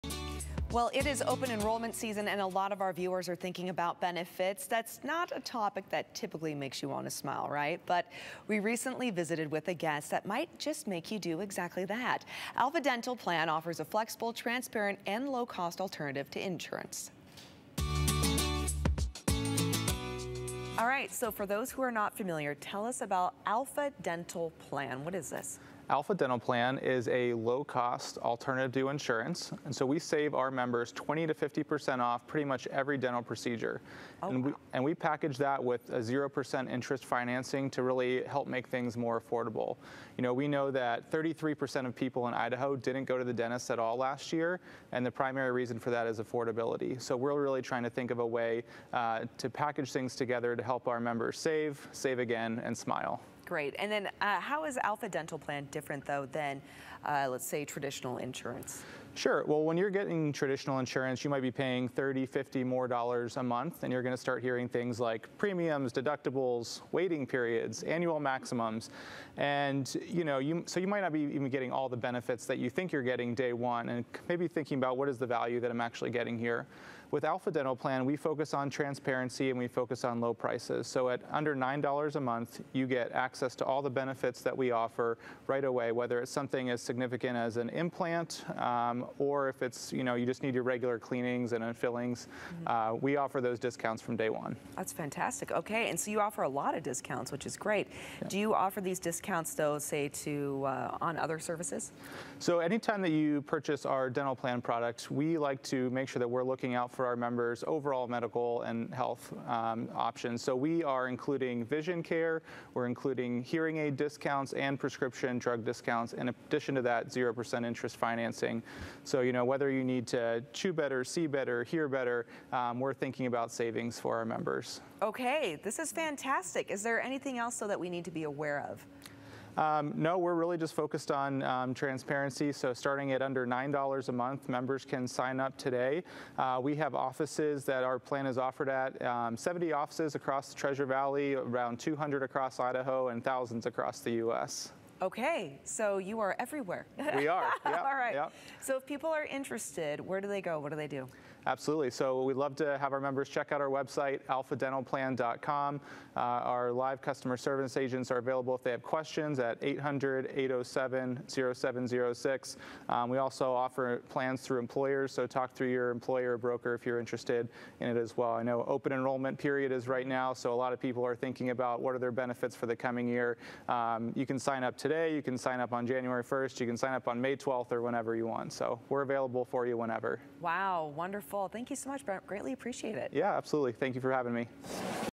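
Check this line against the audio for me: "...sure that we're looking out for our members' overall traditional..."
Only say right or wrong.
wrong.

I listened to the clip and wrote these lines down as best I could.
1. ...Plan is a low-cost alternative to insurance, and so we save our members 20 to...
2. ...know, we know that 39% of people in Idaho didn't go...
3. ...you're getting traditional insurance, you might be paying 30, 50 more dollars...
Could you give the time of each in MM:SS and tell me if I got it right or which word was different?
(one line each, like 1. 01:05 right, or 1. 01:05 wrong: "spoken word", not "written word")
1. 00:26 right
2. 00:40 wrong: "33", not "39"
3. 00:59 right.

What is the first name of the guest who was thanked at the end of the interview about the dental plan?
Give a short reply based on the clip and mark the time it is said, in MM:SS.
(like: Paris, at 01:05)
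Brent, at 03:02.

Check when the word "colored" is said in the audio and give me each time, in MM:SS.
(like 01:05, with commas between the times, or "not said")
not said.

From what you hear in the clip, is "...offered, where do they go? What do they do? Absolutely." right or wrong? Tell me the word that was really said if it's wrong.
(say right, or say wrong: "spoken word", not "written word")
wrong: "interested", not "offered".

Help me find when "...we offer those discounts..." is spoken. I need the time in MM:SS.
01:33.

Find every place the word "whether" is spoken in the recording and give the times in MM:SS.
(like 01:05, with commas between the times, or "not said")
01:25, 01:59.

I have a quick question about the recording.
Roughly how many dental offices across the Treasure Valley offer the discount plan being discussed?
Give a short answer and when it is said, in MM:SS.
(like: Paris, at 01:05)
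70, at 02:19.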